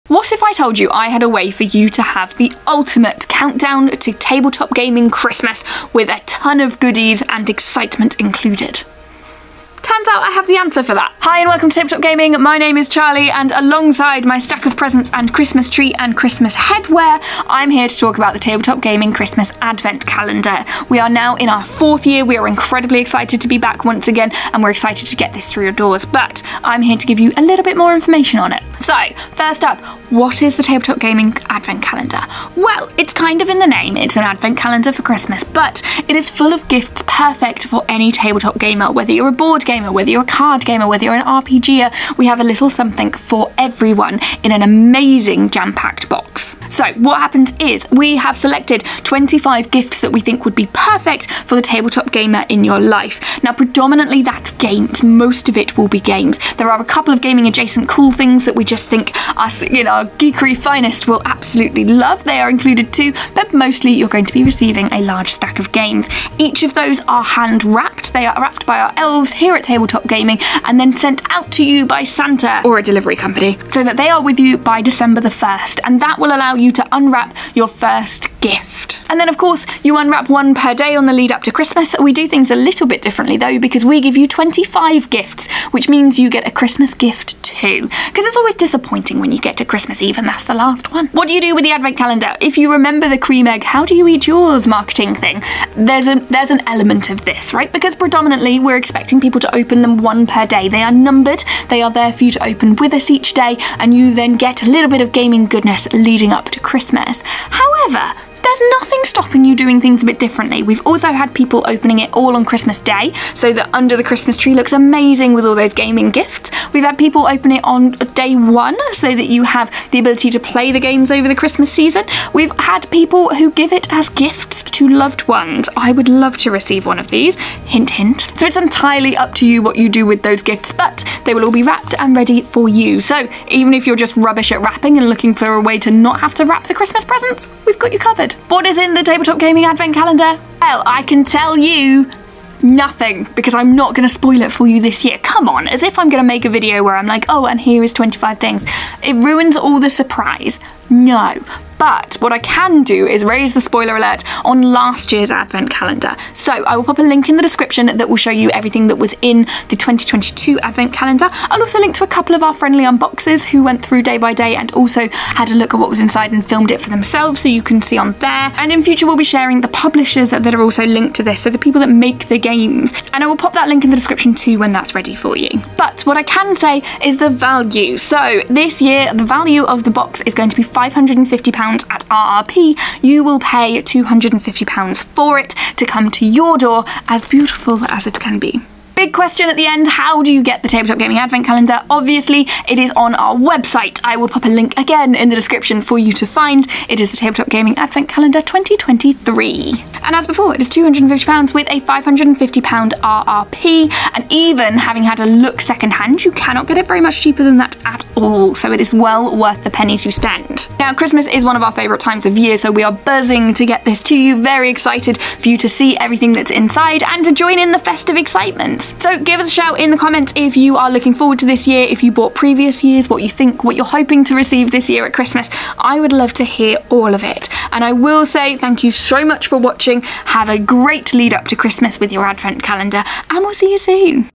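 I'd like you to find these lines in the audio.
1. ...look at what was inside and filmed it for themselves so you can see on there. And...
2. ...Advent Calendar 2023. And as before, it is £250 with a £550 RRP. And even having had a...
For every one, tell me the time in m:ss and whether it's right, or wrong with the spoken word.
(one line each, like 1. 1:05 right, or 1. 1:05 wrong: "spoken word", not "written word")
1. 2:45 right
2. 3:17 right.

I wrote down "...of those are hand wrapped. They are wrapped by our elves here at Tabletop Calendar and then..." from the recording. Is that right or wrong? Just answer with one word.
wrong.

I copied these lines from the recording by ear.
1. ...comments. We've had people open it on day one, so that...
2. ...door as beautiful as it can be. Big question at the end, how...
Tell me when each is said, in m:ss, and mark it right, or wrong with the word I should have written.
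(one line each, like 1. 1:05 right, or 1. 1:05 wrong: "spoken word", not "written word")
1. 1:56 wrong: "gifts", not "comments"
2. 3:06 right.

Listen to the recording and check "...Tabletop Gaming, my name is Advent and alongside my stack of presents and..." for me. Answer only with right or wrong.
wrong.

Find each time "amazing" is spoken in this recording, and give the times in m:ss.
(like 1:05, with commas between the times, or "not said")
0:44, 1:54.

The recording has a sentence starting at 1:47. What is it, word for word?
However, there's nothing stopping you doing things a bit differently.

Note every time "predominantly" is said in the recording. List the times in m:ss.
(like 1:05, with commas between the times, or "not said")
0:53, 1:37.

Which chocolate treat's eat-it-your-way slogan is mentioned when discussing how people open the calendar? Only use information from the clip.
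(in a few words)
Cream Egg.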